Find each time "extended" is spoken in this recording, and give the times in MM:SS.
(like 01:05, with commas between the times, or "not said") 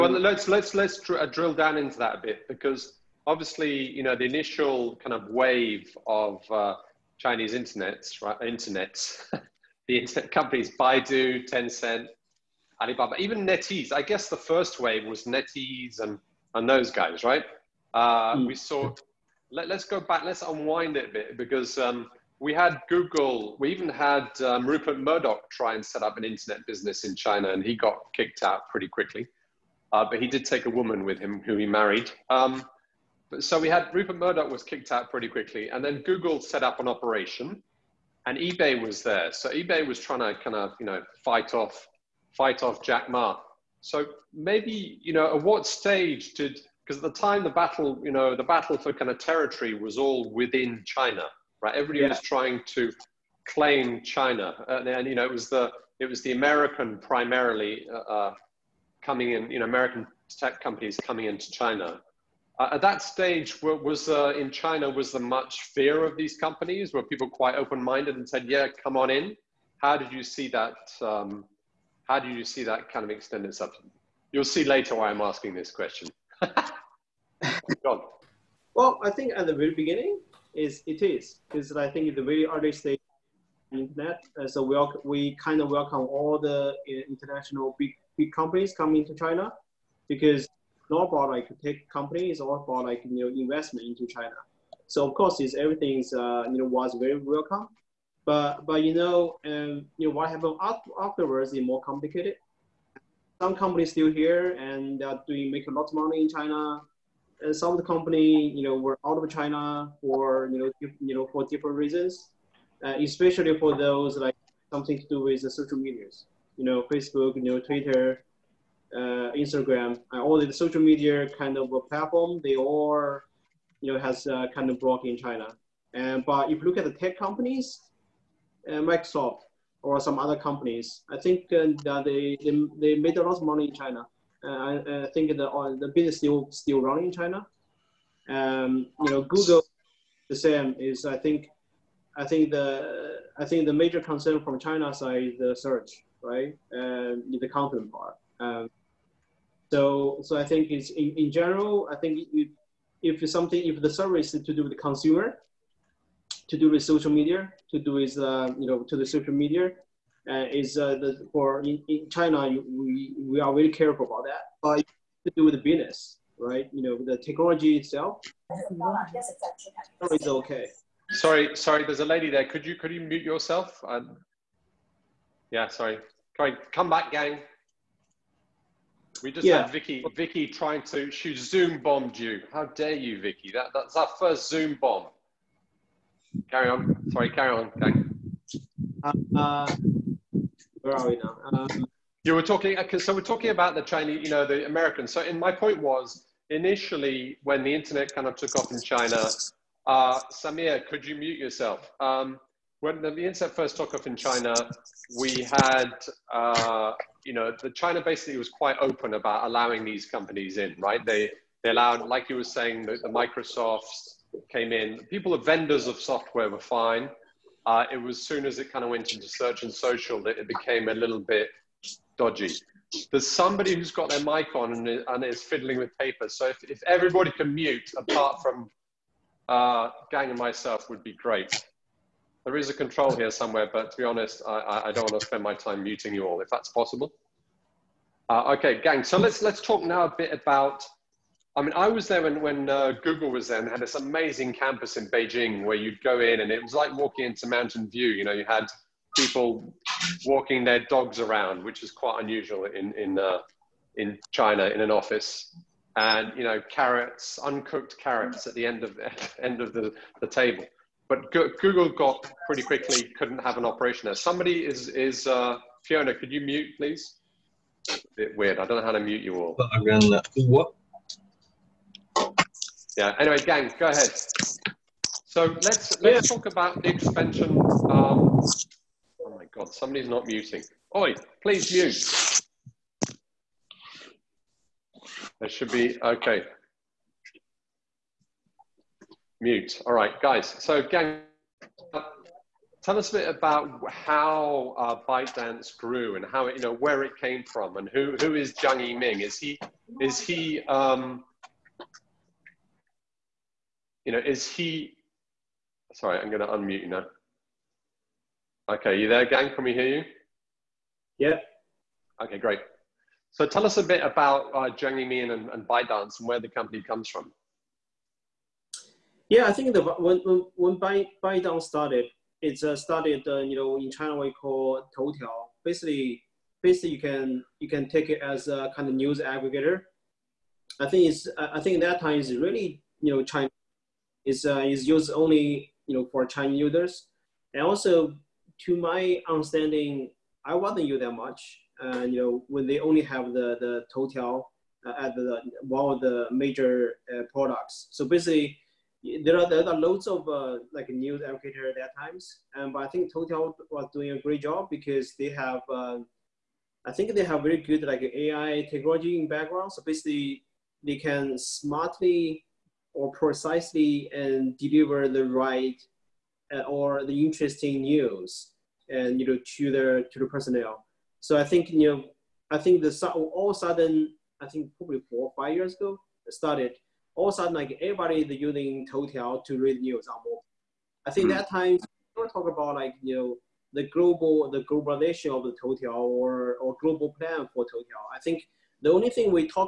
01:13.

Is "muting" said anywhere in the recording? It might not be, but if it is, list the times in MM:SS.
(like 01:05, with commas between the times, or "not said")
03:55, 04:40.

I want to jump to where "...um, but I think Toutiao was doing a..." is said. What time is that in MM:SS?
05:52.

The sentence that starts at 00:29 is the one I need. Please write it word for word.
Uh, but he did take a woman with him who he married.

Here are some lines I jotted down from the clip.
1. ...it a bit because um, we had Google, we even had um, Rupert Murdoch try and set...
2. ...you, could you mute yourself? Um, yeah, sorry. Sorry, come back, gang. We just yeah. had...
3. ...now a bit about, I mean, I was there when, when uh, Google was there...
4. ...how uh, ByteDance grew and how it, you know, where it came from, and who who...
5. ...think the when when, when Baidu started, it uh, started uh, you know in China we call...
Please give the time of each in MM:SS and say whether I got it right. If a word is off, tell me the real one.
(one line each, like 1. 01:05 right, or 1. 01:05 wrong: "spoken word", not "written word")
1. 00:20 right
2. 02:52 right
3. 03:59 right
4. 04:53 right
5. 05:19 right.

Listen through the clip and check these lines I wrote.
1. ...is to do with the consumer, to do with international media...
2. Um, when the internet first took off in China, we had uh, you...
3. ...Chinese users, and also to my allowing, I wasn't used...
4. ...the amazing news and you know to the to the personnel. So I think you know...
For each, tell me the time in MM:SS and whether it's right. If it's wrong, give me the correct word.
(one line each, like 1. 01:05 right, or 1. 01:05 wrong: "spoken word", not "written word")
1. 02:34 wrong: "social", not "international"
2. 03:21 right
3. 05:36 wrong: "understanding", not "allowing"
4. 06:07 wrong: "interesting", not "amazing".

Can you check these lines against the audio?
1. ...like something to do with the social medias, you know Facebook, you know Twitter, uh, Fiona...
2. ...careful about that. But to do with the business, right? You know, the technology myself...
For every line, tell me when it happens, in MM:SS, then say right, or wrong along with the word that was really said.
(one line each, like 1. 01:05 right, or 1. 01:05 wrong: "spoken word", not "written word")
1. 01:54 wrong: "Instagram", not "Fiona"
2. 02:43 wrong: "itself", not "myself".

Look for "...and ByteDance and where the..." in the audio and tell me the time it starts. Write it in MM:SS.
05:15.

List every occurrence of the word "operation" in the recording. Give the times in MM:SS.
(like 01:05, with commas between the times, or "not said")
00:36, 04:23.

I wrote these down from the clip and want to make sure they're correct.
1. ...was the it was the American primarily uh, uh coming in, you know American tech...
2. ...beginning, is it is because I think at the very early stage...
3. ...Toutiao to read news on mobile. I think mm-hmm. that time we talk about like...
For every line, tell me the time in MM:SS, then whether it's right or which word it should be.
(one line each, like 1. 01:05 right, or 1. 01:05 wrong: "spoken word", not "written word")
1. 00:55 right
2. 01:19 right
3. 06:18 right.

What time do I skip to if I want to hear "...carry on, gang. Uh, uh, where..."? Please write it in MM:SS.
03:07.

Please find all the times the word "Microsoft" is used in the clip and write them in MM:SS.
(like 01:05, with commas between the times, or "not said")
02:08, 03:33.